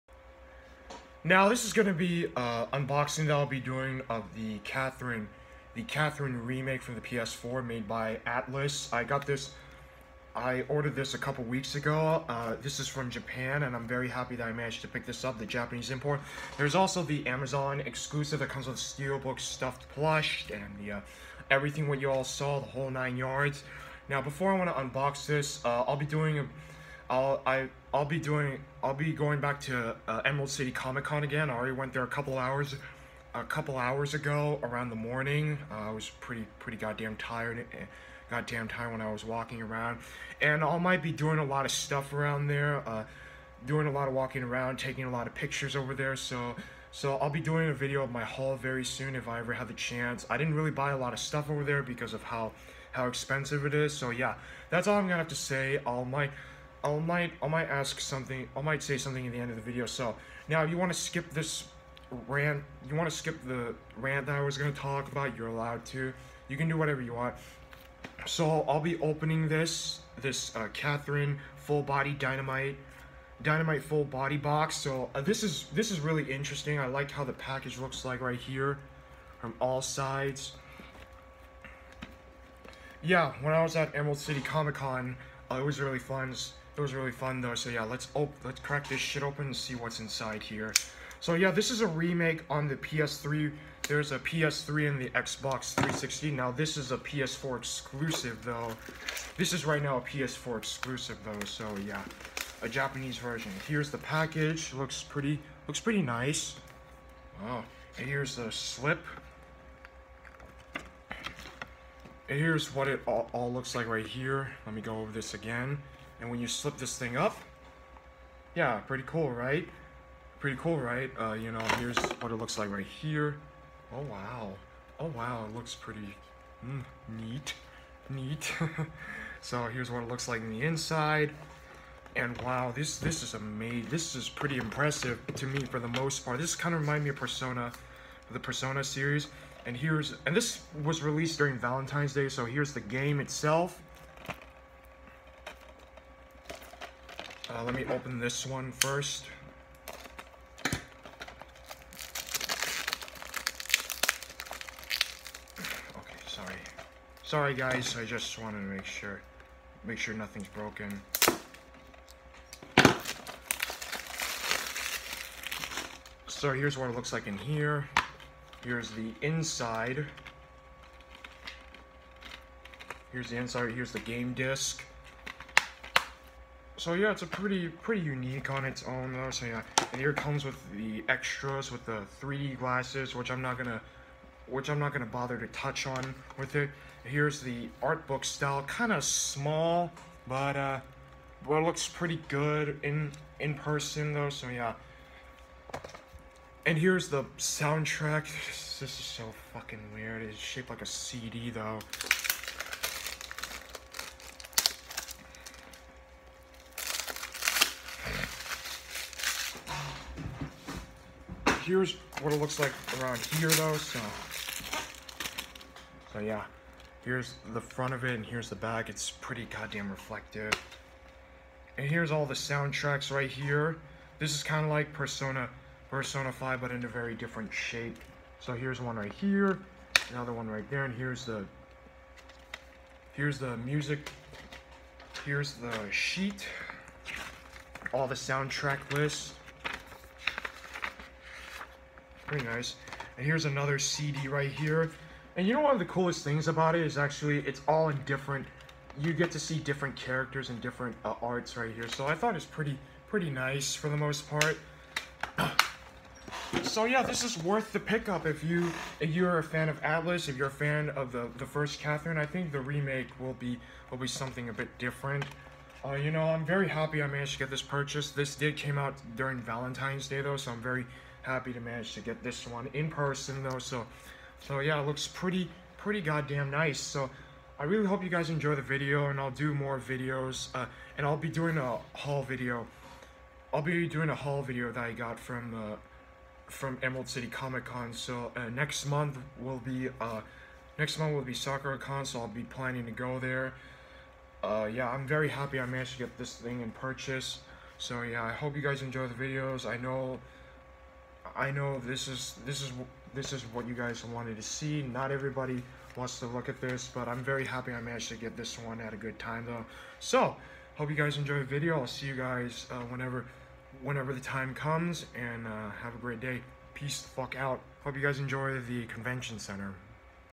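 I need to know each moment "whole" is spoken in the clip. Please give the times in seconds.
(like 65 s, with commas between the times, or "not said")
22 s.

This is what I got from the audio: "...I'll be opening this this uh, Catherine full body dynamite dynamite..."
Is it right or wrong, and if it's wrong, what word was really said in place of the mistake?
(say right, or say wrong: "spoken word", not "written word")
right.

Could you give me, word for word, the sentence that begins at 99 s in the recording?
This is right now a PS4 exclusive though, so yeah.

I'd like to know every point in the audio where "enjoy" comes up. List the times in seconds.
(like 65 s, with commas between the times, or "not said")
278 s, 298 s, 311 s, 318 s.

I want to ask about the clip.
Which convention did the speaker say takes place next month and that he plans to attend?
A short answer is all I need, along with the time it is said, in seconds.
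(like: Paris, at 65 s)
Sakura Con, at 291 s.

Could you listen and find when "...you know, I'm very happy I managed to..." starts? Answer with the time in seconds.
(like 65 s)
265 s.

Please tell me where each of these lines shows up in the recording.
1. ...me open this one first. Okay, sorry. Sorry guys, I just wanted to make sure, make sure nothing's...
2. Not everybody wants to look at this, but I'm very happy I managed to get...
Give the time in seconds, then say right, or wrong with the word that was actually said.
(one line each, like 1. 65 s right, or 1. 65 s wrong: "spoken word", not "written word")
1. 147 s right
2. 304 s right.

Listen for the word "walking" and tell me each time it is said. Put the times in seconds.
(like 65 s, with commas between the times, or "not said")
39 s, 44 s.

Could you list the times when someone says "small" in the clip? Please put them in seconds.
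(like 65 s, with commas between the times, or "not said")
189 s.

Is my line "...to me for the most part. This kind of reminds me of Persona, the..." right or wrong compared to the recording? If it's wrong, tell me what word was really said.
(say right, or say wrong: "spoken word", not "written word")
right.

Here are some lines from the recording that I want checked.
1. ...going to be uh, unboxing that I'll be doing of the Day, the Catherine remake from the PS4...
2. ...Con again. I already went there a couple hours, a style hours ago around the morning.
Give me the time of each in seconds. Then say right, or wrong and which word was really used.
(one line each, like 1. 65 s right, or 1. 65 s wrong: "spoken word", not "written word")
1. 1 s wrong: "Catherine", not "Day"
2. 31 s wrong: "couple", not "style".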